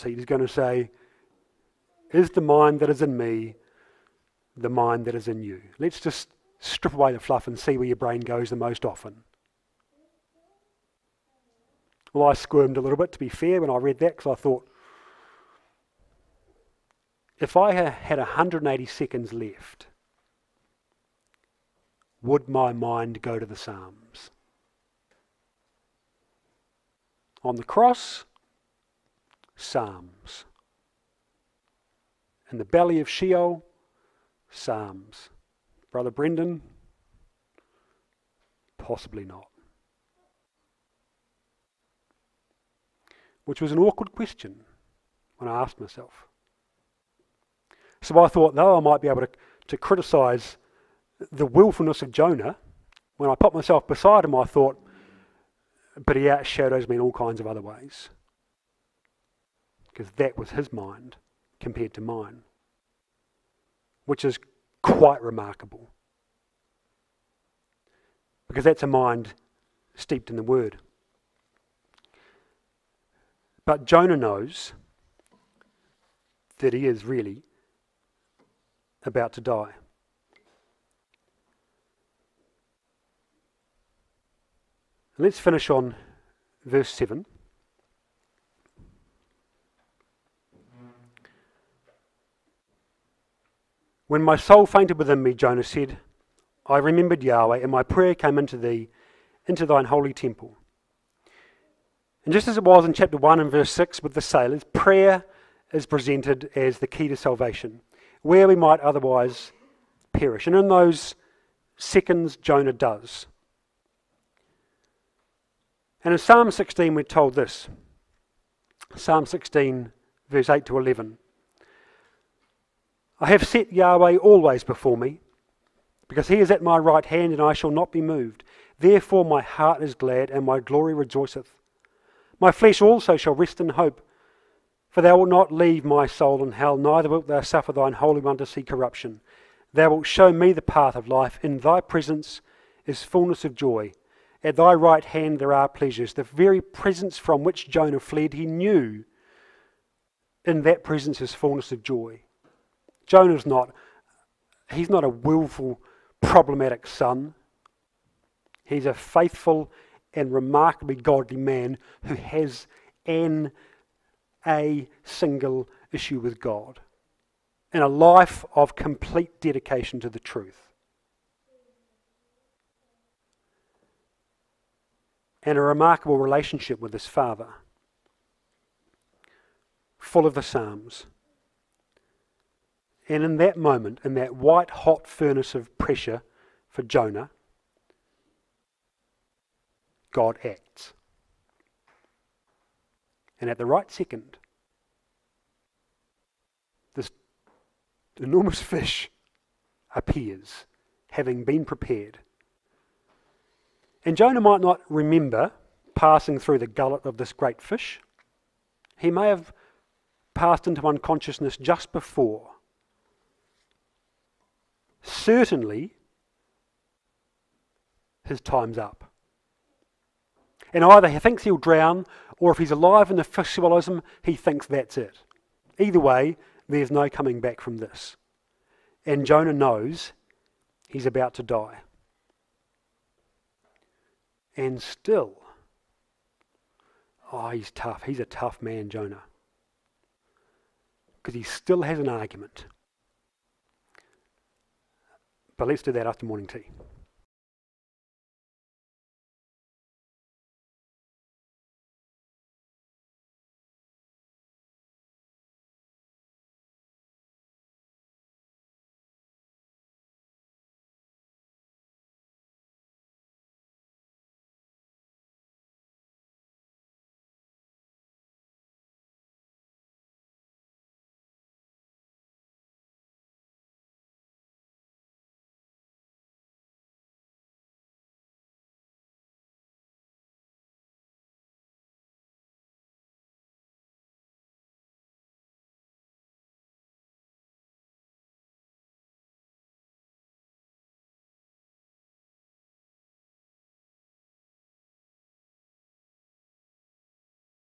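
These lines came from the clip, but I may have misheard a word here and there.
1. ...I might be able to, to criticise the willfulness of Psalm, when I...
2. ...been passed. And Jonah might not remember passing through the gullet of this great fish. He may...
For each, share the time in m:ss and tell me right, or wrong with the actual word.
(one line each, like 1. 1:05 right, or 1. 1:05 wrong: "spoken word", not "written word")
1. 0:48 wrong: "Jonah", not "Psalm"
2. 3:21 wrong: "prepared", not "passed".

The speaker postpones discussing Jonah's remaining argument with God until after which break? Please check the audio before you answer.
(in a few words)
morning tea.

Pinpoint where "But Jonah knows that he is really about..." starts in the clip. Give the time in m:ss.
1:13.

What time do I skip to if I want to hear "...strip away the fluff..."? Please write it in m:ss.
0:06.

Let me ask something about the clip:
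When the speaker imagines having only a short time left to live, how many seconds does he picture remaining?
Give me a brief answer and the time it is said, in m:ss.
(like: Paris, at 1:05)
180, at 0:18.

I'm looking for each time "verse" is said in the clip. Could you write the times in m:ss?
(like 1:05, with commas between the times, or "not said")
1:26, 1:43, 2:00.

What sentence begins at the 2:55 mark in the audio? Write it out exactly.
And a remarkable relationship with his father, full of the Psalms.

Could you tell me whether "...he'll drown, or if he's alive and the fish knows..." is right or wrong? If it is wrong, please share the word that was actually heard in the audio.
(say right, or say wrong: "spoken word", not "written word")
wrong: "swallows", not "knows".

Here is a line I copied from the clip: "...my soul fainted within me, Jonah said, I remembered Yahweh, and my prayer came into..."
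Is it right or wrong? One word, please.
right.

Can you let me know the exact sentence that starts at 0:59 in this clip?
Because that was his mind compared to mine, which is quite remarkable.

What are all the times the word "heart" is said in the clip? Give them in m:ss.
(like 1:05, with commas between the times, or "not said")
2:09.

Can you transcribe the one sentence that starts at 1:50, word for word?
And in those seconds, Jonah does.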